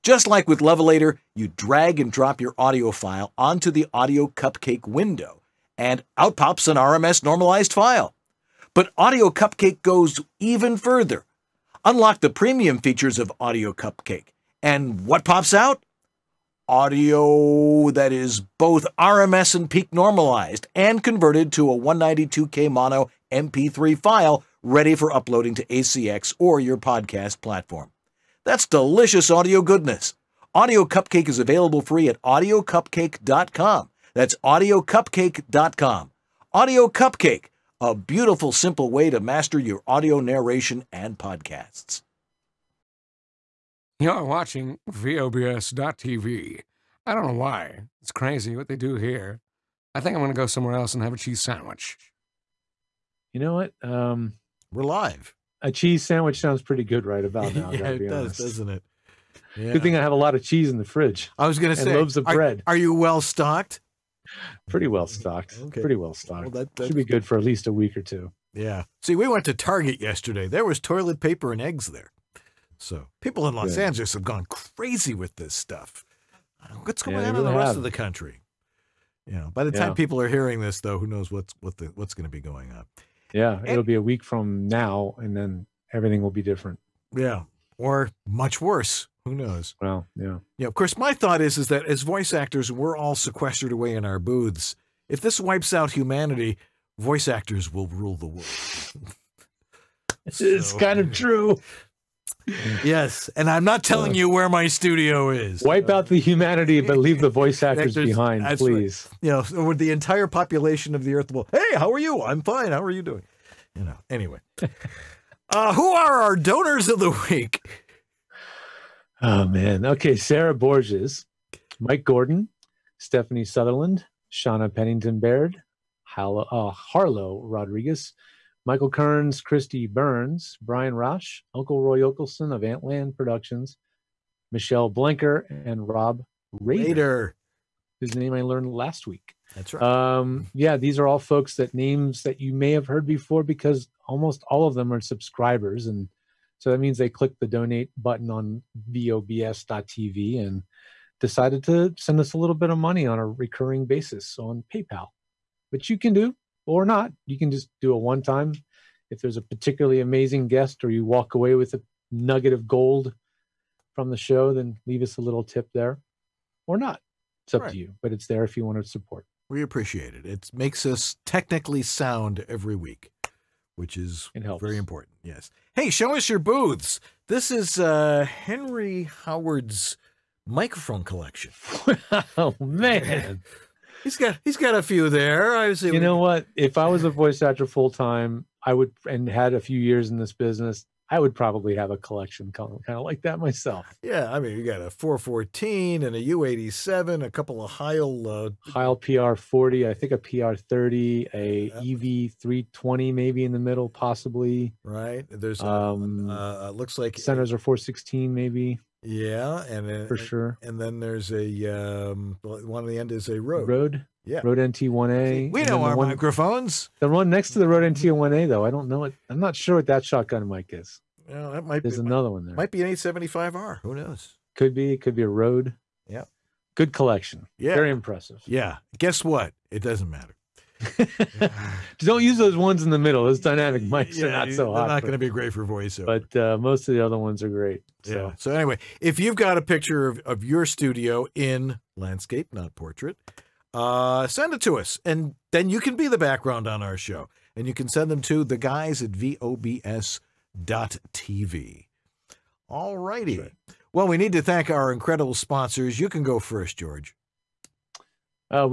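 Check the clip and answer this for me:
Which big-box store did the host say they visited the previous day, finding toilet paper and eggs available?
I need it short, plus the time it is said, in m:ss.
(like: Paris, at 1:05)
Target, at 1:09.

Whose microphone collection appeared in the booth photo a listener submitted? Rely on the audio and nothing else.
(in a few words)
Henry Howard.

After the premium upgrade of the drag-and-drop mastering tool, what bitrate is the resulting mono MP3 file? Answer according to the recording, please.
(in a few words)
192K.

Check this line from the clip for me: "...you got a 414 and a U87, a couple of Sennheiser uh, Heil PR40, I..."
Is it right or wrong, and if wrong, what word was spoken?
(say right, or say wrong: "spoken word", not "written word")
wrong: "Heil", not "Sennheiser".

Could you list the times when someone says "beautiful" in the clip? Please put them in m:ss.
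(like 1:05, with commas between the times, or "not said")
0:37.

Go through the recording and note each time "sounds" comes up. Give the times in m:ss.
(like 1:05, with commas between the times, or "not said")
0:56, 2:51.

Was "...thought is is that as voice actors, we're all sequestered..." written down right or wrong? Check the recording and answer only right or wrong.
right.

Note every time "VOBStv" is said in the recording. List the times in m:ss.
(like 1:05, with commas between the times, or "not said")
0:44, 2:28, 4:09.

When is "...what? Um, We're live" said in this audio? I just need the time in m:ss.
0:53.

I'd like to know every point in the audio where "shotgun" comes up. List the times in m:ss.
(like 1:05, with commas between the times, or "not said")
3:40.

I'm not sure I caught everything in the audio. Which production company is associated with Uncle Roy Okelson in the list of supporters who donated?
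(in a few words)
Antland Productions.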